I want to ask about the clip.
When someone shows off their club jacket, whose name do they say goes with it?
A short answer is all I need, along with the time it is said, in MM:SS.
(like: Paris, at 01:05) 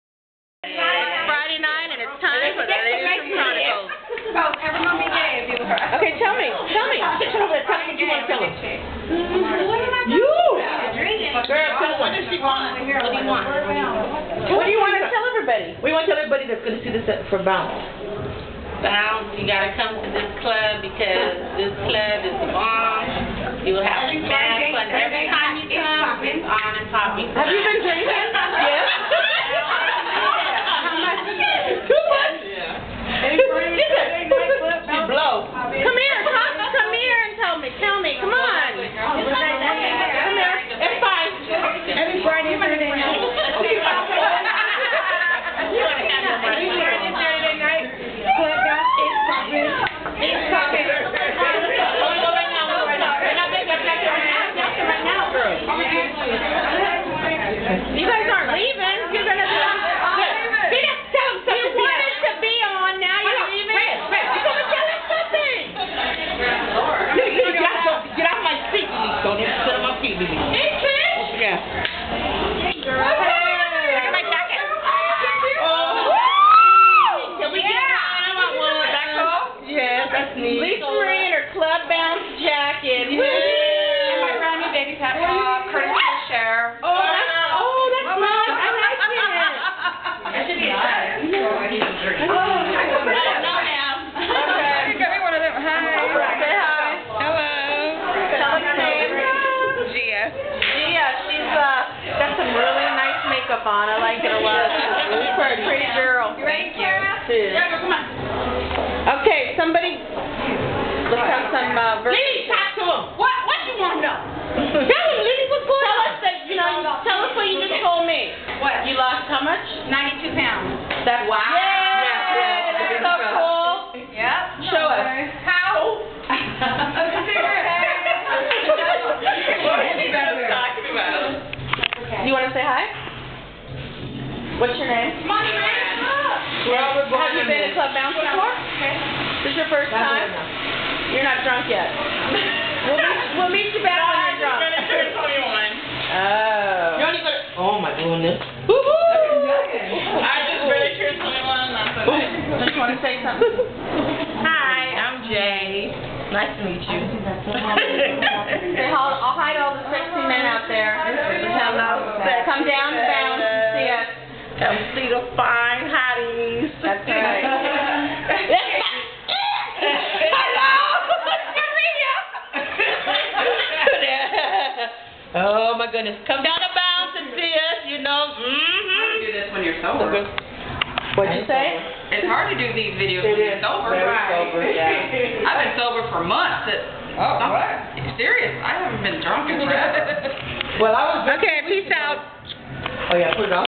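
Lisa Marie, at 01:20.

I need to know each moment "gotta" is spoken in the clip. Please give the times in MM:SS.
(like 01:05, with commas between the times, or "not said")
00:19.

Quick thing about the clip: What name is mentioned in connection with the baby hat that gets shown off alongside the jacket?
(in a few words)
Curtis Fisher.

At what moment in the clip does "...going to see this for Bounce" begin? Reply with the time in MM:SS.
00:16.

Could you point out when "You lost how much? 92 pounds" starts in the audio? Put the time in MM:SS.
01:58.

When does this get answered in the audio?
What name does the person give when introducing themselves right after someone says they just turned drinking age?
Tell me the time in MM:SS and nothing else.
02:35.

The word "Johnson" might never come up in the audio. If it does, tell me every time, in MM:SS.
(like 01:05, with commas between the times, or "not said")
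not said.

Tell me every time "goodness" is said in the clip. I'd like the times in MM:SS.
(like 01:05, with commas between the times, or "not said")
02:27, 02:55.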